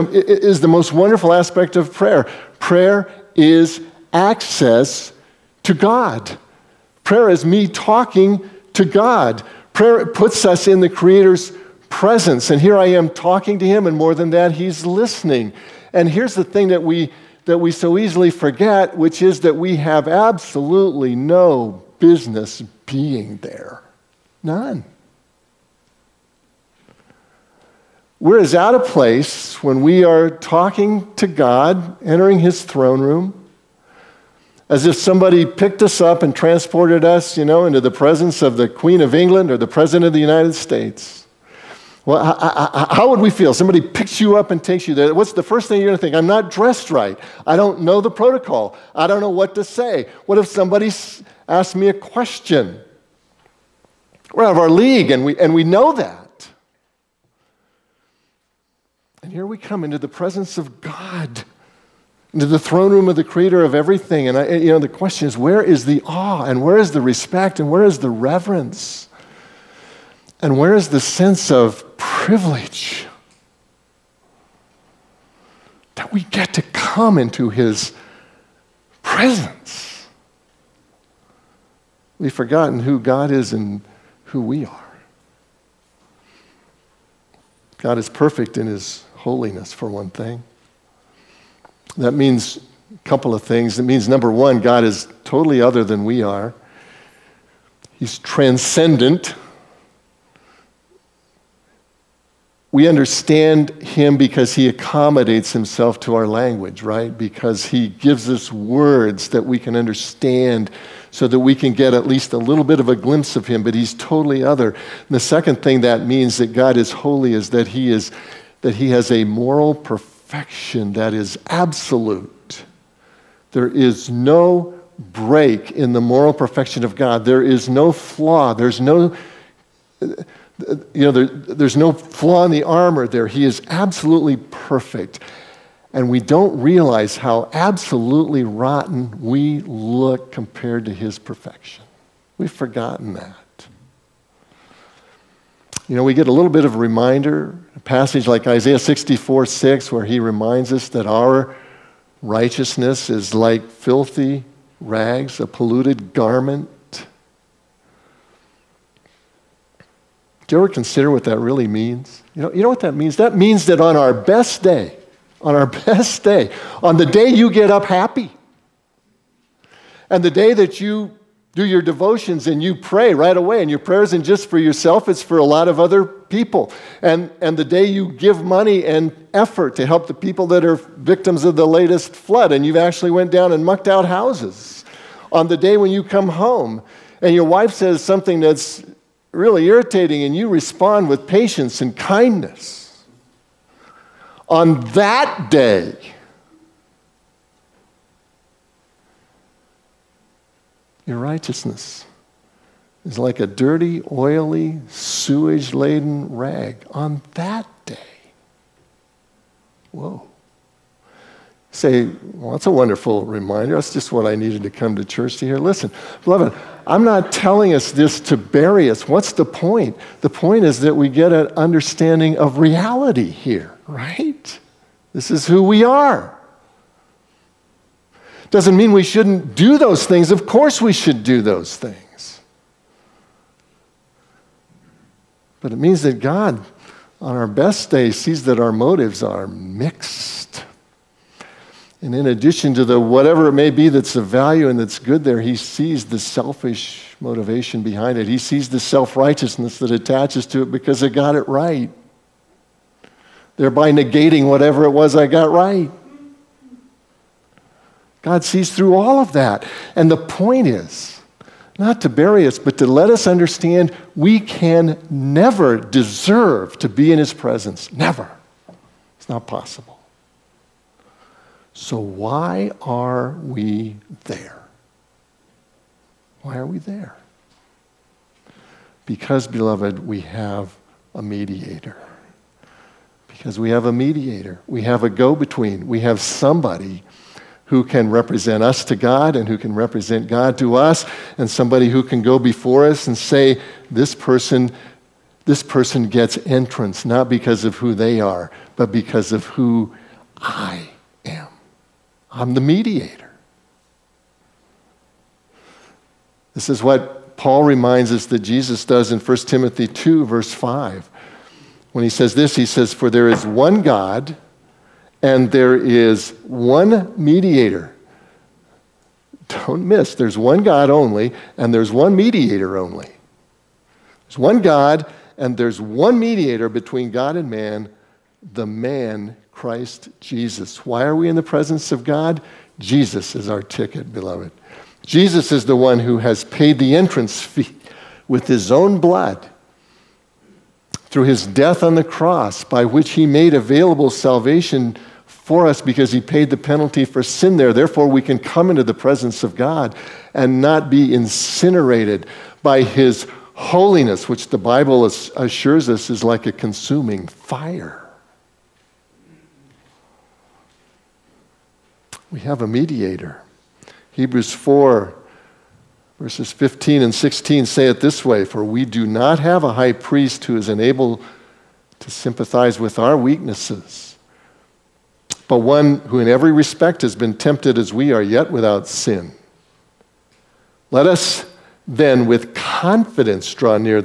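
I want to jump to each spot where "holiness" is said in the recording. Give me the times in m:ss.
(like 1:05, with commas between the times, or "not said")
1:29, 5:53.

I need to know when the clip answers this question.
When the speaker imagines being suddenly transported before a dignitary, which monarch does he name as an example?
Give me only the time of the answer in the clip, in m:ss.
0:38.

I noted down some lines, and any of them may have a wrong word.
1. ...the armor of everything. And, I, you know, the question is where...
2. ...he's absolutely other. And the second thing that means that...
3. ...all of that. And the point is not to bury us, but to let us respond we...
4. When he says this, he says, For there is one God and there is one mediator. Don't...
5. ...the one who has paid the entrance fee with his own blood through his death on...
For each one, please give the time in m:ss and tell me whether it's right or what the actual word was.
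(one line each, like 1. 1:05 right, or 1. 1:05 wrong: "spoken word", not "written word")
1. 1:03 wrong: "creator", not "armor"
2. 1:53 wrong: "totally", not "absolutely"
3. 4:18 wrong: "understand", not "respond"
4. 5:11 right
5. 5:35 right.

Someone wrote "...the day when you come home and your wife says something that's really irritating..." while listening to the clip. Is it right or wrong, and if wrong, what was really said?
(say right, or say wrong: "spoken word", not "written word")
right.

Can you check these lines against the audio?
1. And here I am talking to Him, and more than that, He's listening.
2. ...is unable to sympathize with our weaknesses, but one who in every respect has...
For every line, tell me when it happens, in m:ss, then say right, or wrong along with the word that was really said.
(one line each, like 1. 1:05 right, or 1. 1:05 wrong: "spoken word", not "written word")
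1. 0:12 right
2. 6:10 right.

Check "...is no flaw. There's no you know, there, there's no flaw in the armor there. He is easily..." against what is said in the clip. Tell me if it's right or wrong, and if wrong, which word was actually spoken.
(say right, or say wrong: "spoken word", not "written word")
wrong: "absolutely", not "easily".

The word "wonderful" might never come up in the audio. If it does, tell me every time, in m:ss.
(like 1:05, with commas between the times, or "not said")
0:00, 3:32.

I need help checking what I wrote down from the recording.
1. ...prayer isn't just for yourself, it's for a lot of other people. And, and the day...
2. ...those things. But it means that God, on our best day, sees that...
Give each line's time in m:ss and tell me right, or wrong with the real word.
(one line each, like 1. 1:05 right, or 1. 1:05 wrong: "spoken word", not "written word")
1. 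2:53 right
2. 3:51 right.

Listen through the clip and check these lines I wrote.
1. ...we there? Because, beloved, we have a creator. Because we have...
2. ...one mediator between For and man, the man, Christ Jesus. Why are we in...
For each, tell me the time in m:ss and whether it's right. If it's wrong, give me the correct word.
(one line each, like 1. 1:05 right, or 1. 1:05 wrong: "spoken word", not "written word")
1. 4:36 wrong: "mediator", not "creator"
2. 5:25 wrong: "God", not "For".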